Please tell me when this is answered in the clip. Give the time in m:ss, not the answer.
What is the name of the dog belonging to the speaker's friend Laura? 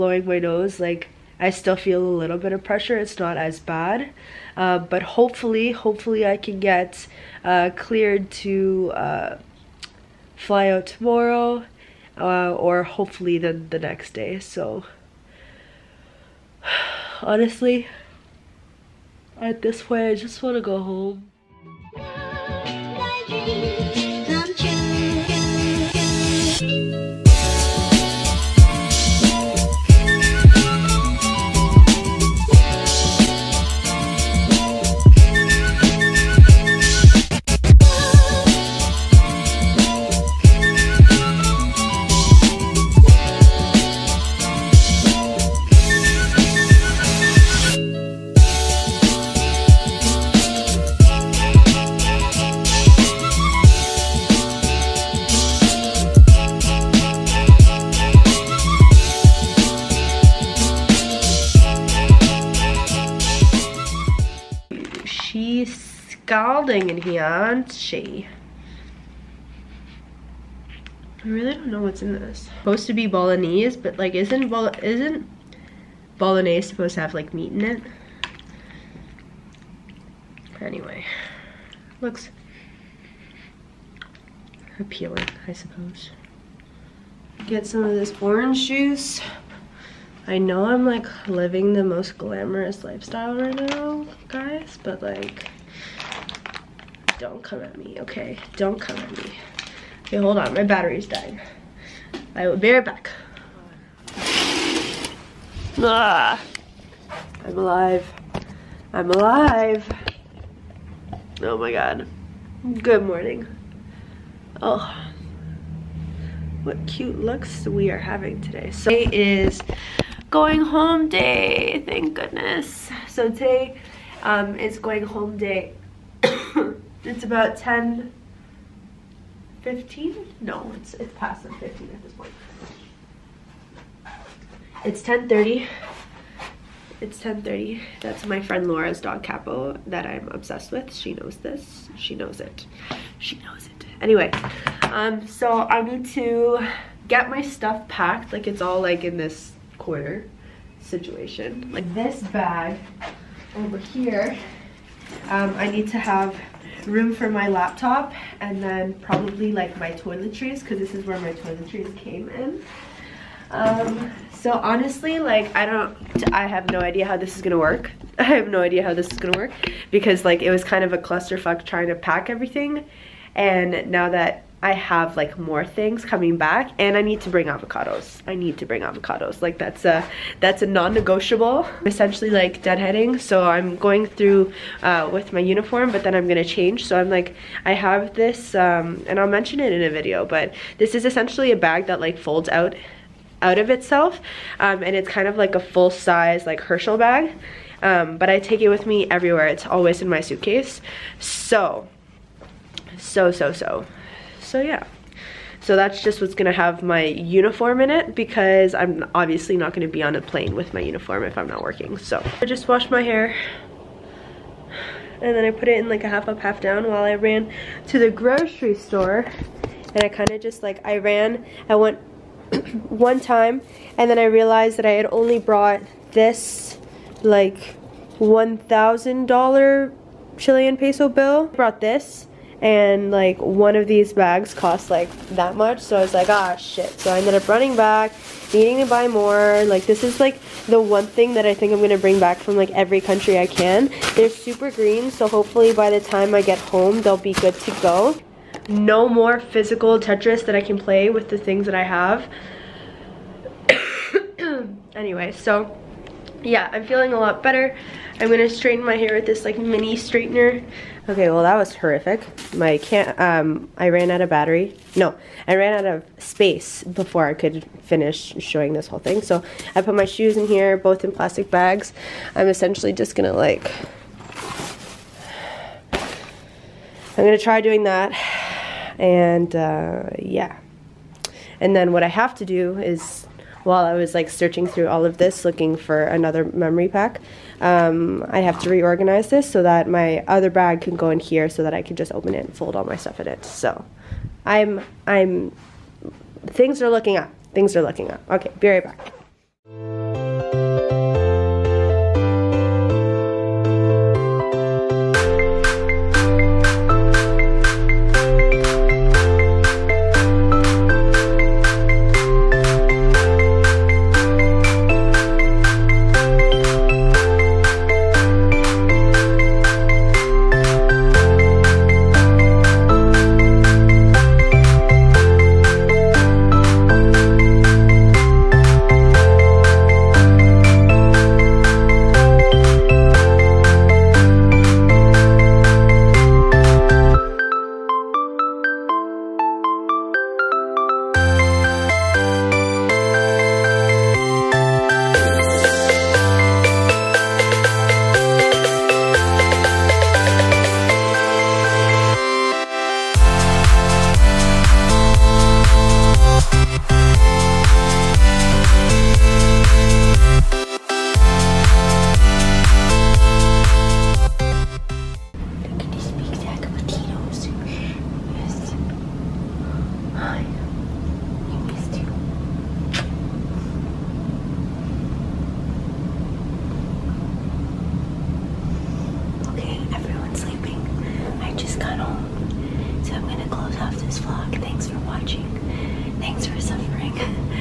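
2:19.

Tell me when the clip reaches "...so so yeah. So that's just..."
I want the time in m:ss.
3:23.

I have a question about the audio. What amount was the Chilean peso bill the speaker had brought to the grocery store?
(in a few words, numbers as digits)
1,000 Chilean pesos.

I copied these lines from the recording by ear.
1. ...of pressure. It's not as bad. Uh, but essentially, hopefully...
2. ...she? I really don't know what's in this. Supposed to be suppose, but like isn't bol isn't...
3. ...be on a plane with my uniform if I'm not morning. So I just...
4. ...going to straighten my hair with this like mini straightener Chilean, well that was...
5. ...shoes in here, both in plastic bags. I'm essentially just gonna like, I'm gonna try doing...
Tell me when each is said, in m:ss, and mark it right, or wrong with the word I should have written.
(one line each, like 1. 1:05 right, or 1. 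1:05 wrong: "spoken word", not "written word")
1. 0:02 wrong: "hopefully", not "essentially"
2. 1:07 wrong: "bolognese", not "suppose"
3. 3:29 wrong: "working", not "morning"
4. 4:18 wrong: "Okay", not "Chilean"
5. 4:30 right.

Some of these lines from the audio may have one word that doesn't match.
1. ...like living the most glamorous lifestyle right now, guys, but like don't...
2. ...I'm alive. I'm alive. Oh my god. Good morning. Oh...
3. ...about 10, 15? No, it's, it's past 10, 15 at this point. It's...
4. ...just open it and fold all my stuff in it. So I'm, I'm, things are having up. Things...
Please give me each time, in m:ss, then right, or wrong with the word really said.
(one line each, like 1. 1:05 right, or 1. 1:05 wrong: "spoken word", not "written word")
1. 1:30 right
2. 1:47 right
3. 2:07 right
4. 4:51 wrong: "looking", not "having".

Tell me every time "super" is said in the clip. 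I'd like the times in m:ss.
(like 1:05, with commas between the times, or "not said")
4:04.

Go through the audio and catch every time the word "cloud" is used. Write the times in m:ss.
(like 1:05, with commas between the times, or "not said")
not said.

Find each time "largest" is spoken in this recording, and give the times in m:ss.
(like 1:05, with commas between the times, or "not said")
not said.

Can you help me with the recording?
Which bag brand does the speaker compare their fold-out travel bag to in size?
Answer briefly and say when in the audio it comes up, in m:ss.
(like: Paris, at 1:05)
Herschel, at 3:16.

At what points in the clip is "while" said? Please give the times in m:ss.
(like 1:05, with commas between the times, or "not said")
3:36, 4:43.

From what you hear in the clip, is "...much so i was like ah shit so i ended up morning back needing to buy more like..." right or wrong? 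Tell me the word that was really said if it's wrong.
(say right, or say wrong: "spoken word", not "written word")
wrong: "running", not "morning".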